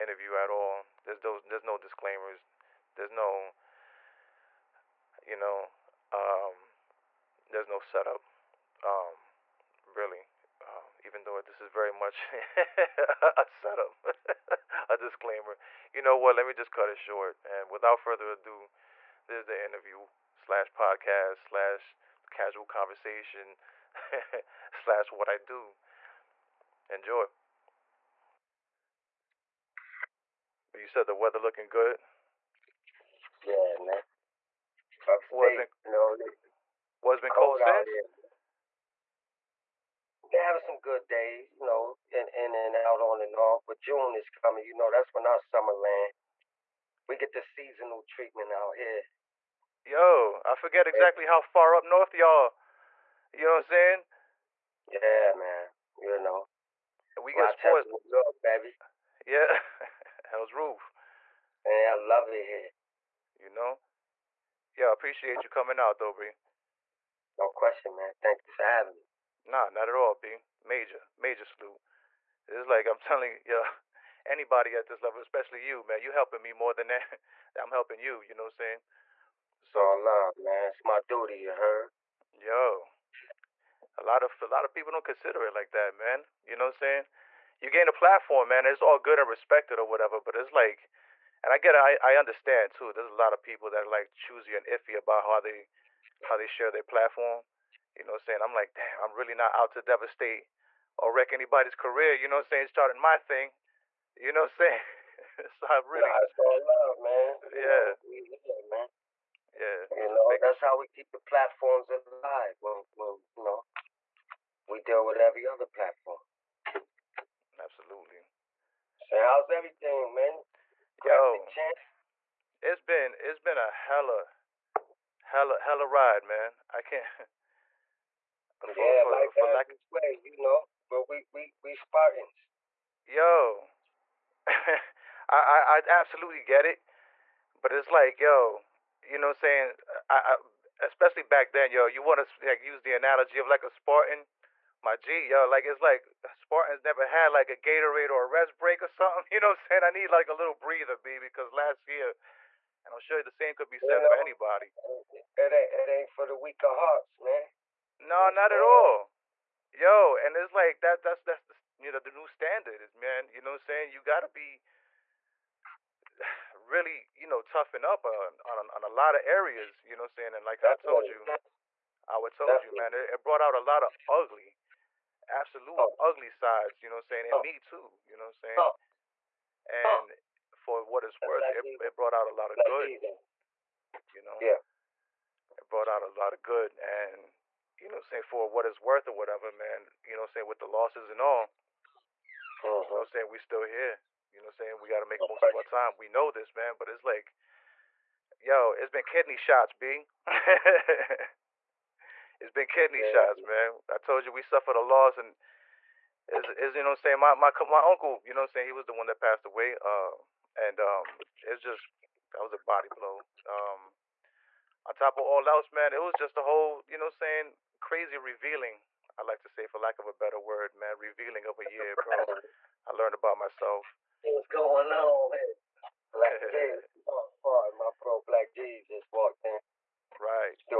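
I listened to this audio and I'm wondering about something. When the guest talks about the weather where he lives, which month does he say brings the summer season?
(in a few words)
June.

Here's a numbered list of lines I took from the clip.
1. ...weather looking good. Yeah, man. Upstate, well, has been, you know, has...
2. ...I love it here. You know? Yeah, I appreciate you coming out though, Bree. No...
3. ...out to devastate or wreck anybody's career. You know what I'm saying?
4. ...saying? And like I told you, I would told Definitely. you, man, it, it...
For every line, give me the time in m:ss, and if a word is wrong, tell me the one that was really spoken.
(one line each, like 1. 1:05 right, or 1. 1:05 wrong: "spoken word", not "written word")
1. 0:31 right
2. 1:01 right
3. 1:39 right
4. 2:50 right.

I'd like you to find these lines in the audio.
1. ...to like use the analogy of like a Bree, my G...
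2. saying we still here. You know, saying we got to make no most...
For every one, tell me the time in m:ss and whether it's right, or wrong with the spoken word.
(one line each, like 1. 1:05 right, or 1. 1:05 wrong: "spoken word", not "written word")
1. 2:22 wrong: "Spartan", not "Bree"
2. 3:13 right.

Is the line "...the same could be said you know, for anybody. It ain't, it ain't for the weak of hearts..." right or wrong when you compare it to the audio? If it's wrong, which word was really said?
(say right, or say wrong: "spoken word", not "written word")
right.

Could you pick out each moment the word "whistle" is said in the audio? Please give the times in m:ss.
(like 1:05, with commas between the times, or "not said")
not said.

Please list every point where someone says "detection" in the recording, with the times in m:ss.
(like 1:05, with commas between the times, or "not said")
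not said.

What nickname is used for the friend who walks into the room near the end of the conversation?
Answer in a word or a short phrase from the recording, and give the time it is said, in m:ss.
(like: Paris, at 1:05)
Black Jeeves, at 3:48.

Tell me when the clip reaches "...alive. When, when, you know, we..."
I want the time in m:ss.
1:51.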